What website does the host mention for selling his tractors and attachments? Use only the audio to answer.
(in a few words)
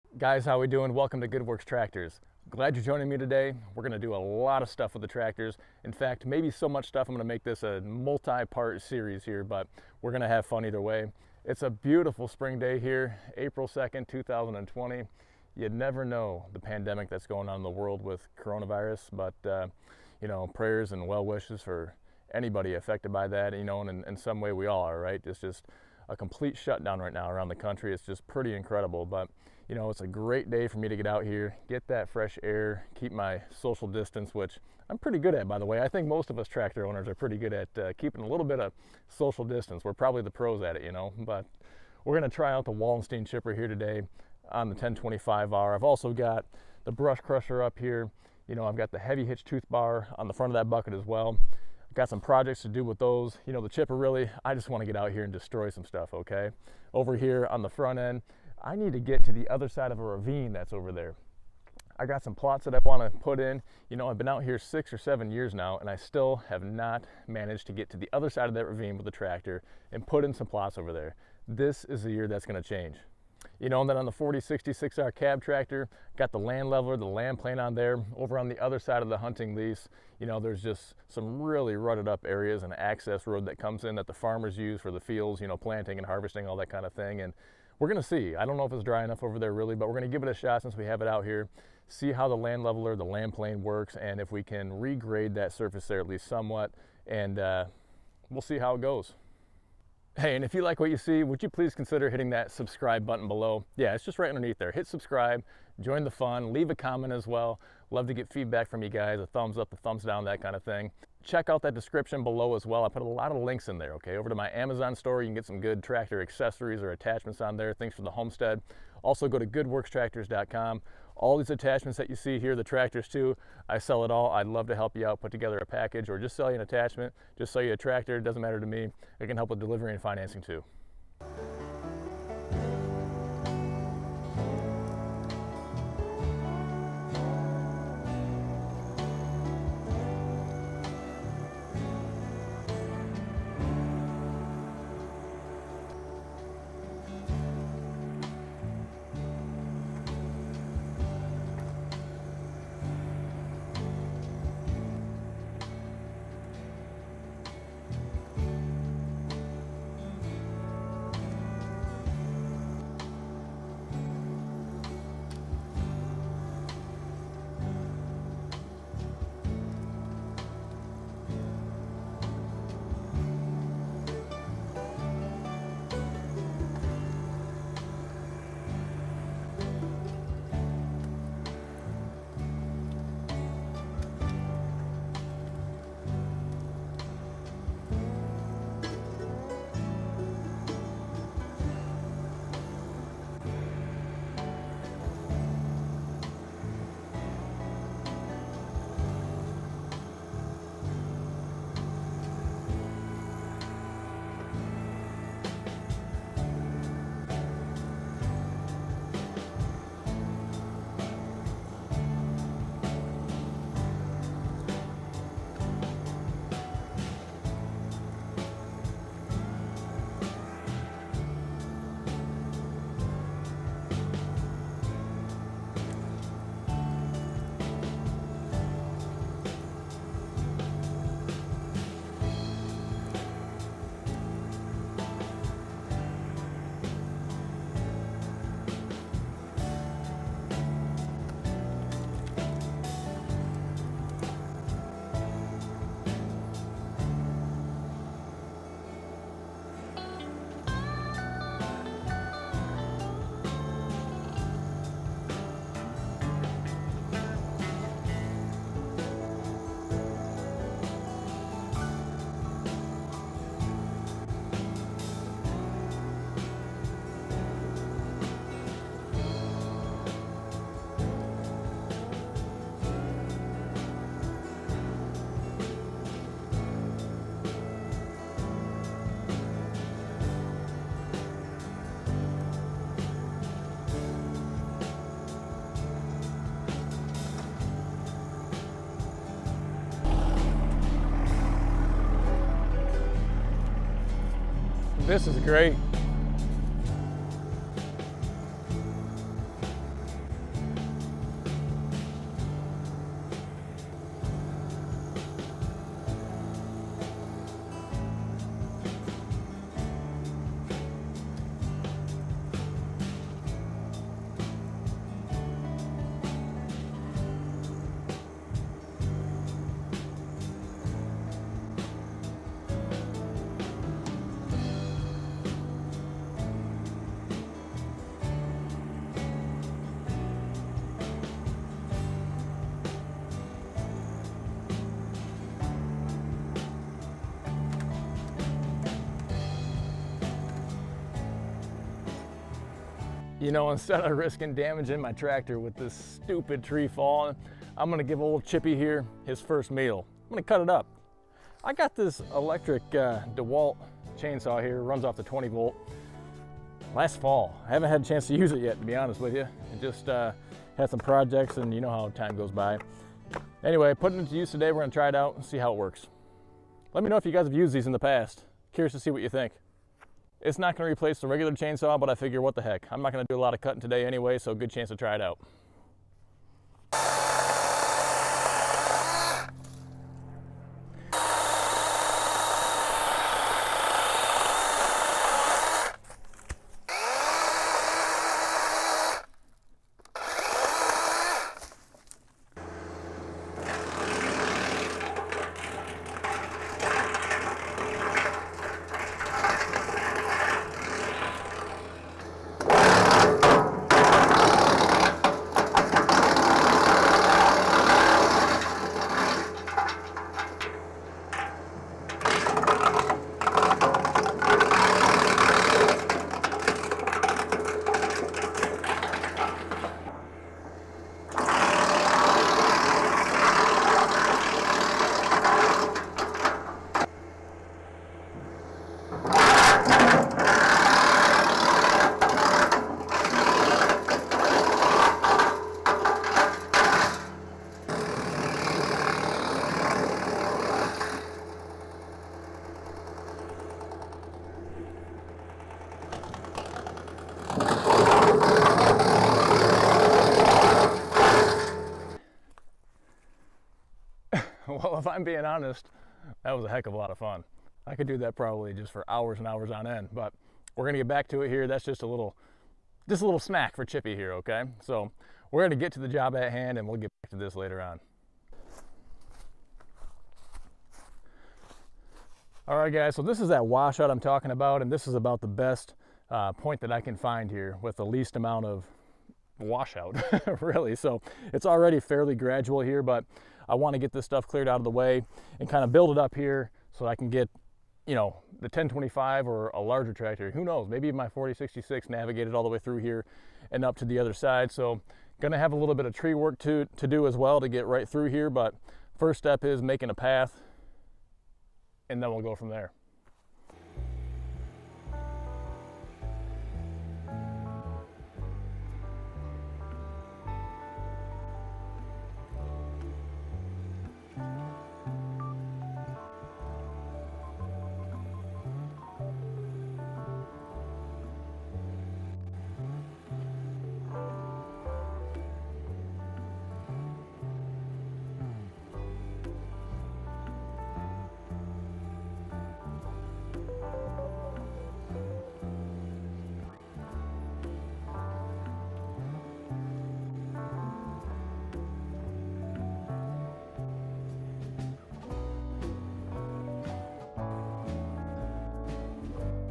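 goodworkstractors.com.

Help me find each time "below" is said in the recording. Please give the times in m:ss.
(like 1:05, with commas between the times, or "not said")
1:43, 1:52.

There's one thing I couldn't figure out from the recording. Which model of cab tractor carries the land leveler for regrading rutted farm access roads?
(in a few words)
4066R.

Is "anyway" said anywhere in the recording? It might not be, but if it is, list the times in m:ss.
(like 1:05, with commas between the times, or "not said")
6:03, 6:14.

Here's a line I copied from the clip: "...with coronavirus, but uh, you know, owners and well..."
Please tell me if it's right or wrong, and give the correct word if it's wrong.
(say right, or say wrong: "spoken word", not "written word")
wrong: "prayers", not "owners".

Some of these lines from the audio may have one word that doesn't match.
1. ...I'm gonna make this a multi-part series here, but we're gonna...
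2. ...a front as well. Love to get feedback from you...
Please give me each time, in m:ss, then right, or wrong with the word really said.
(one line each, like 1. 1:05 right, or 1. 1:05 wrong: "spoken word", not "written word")
1. 0:07 right
2. 1:46 wrong: "comment", not "front".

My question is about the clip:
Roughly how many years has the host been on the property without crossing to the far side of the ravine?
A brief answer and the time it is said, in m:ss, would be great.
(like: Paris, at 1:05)
6 or 7, at 1:04.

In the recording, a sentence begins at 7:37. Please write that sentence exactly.
I could do that probably just for hours and hours on end, but we're gonna get back to it here.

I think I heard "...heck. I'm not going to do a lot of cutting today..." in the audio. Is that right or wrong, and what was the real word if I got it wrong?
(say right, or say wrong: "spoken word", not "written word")
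right.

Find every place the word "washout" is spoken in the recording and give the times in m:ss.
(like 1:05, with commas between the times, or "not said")
7:53, 7:59.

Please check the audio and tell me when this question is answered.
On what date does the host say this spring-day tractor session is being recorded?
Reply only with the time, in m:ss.
0:13.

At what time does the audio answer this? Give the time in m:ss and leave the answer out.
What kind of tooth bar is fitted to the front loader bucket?
0:48.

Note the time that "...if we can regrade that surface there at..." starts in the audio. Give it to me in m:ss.
1:34.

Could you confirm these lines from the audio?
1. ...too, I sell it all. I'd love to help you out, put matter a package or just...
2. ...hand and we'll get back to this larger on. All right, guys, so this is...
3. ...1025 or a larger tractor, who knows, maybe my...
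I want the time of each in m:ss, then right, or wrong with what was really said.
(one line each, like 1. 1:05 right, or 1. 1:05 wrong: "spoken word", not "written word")
1. 2:03 wrong: "together", not "matter"
2. 7:46 wrong: "later", not "larger"
3. 8:08 right.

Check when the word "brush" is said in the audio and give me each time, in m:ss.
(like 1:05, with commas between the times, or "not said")
0:46.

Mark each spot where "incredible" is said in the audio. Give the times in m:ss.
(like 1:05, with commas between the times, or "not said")
0:28.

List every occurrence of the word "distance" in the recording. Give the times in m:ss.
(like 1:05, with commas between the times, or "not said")
0:33, 0:39.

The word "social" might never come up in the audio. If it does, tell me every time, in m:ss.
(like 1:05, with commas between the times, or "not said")
0:33, 0:39.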